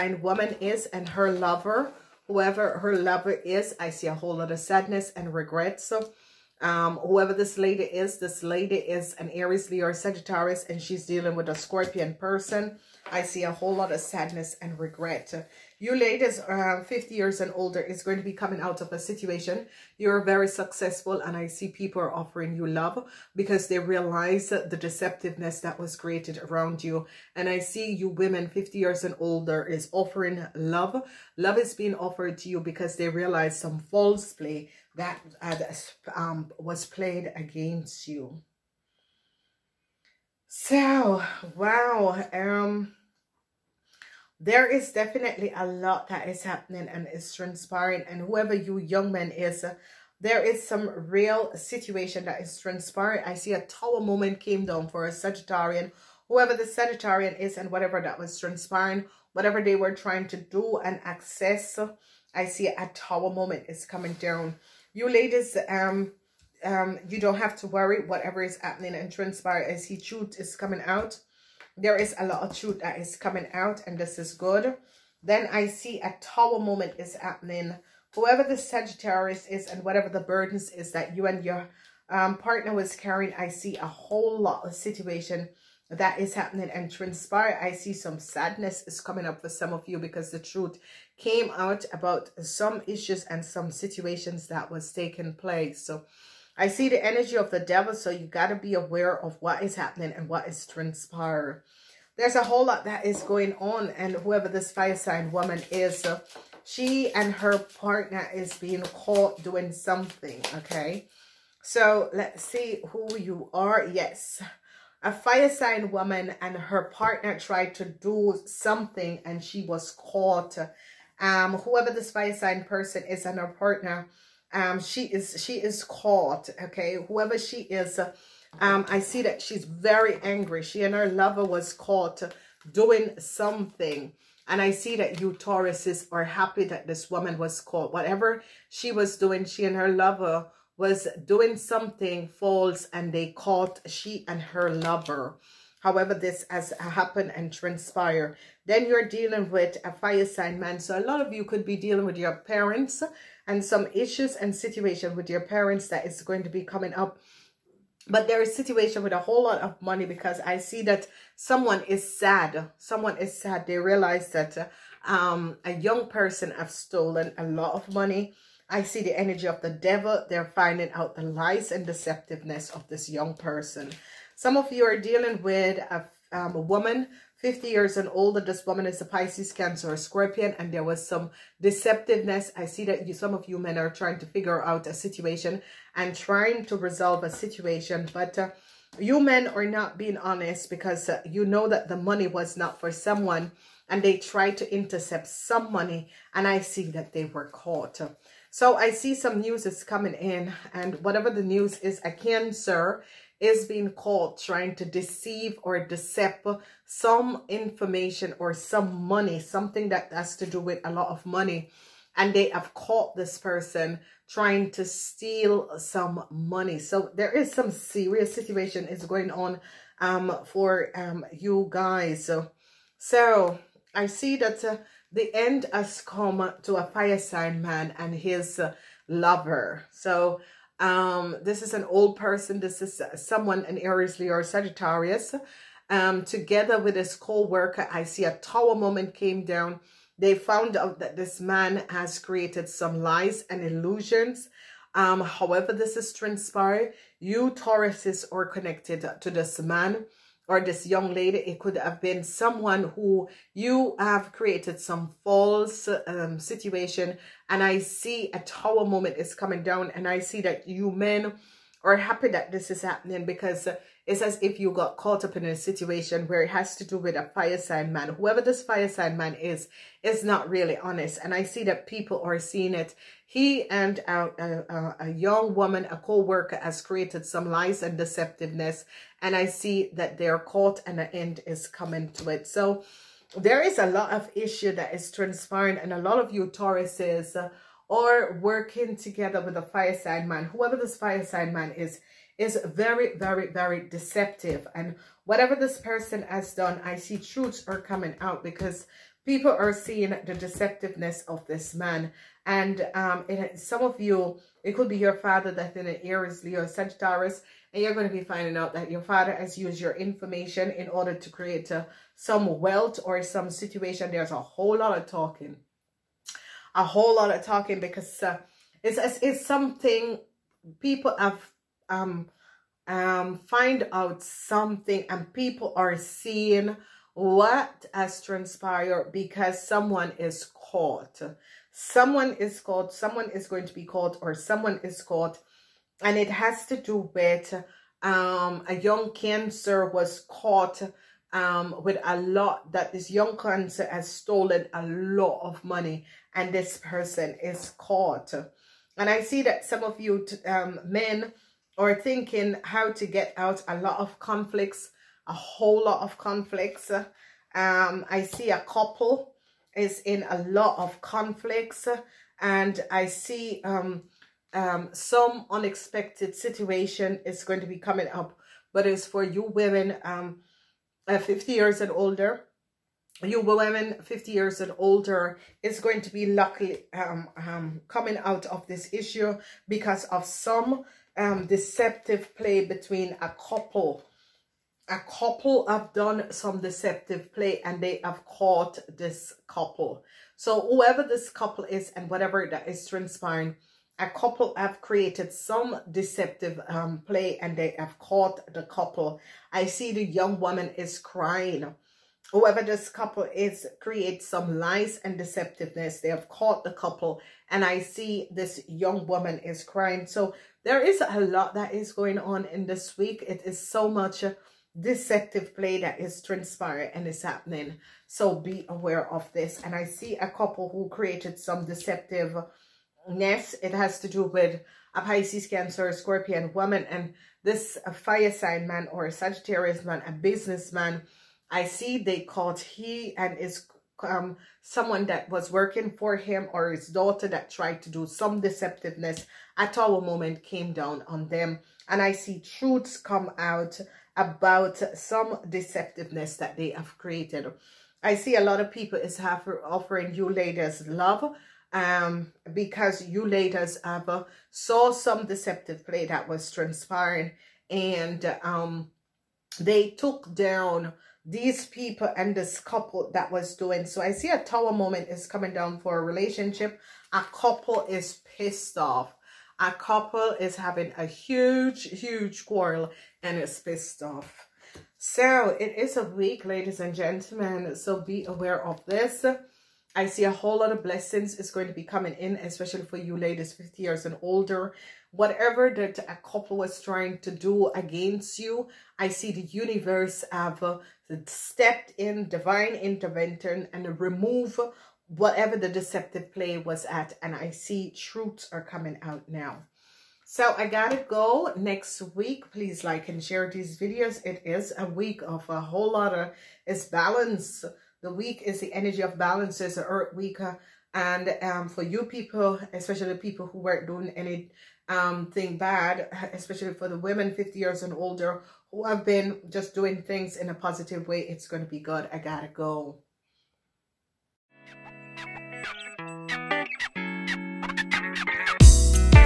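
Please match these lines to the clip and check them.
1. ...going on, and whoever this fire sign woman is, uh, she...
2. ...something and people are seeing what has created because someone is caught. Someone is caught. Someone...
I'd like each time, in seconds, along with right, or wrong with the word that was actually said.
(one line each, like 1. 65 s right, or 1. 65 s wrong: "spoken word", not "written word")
1. 103 s right
2. 324 s wrong: "transpired", not "created".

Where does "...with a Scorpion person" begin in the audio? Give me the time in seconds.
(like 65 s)
11 s.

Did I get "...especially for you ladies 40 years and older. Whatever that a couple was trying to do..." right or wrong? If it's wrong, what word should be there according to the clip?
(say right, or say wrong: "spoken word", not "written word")
wrong: "50", not "40".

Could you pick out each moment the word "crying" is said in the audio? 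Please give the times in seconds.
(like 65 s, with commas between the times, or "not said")
400 s, 409 s.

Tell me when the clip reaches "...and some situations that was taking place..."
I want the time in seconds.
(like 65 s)
93 s.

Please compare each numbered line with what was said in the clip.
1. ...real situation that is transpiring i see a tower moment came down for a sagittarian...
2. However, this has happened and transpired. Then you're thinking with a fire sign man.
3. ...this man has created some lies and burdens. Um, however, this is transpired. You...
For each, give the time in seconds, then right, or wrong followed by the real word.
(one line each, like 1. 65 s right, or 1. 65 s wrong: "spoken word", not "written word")
1. 51 s right
2. 145 s wrong: "dealing", not "thinking"
3. 241 s wrong: "illusions", not "burdens".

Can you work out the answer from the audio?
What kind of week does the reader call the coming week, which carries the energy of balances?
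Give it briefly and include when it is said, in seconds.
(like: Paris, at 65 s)
earth week, at 509 s.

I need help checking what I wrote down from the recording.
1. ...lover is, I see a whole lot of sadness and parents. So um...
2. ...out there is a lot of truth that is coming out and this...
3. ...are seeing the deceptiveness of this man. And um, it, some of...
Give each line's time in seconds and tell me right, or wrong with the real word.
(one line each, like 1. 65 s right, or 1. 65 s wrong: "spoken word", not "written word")
1. 2 s wrong: "regrets", not "parents"
2. 70 s right
3. 299 s right.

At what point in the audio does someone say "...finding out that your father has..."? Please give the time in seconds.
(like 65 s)
308 s.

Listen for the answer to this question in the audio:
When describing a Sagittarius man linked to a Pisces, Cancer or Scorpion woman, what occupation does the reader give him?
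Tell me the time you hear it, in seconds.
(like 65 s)
430 s.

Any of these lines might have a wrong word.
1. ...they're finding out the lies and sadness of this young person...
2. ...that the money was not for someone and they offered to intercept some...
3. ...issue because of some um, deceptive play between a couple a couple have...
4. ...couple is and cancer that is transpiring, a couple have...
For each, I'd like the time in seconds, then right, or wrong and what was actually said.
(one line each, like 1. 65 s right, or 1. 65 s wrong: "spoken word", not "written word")
1. 170 s wrong: "deceptiveness", not "sadness"
2. 191 s wrong: "tried", not "offered"
3. 378 s right
4. 391 s wrong: "whatever", not "cancer".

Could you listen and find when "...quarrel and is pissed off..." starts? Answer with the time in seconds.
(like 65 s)
472 s.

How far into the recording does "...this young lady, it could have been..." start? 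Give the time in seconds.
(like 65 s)
250 s.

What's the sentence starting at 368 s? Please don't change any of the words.
But it's for you women um, uh, 50 years and older.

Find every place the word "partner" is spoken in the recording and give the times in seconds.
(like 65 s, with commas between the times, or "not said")
82 s, 107 s, 116 s, 123 s.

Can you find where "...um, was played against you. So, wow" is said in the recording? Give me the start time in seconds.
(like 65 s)
36 s.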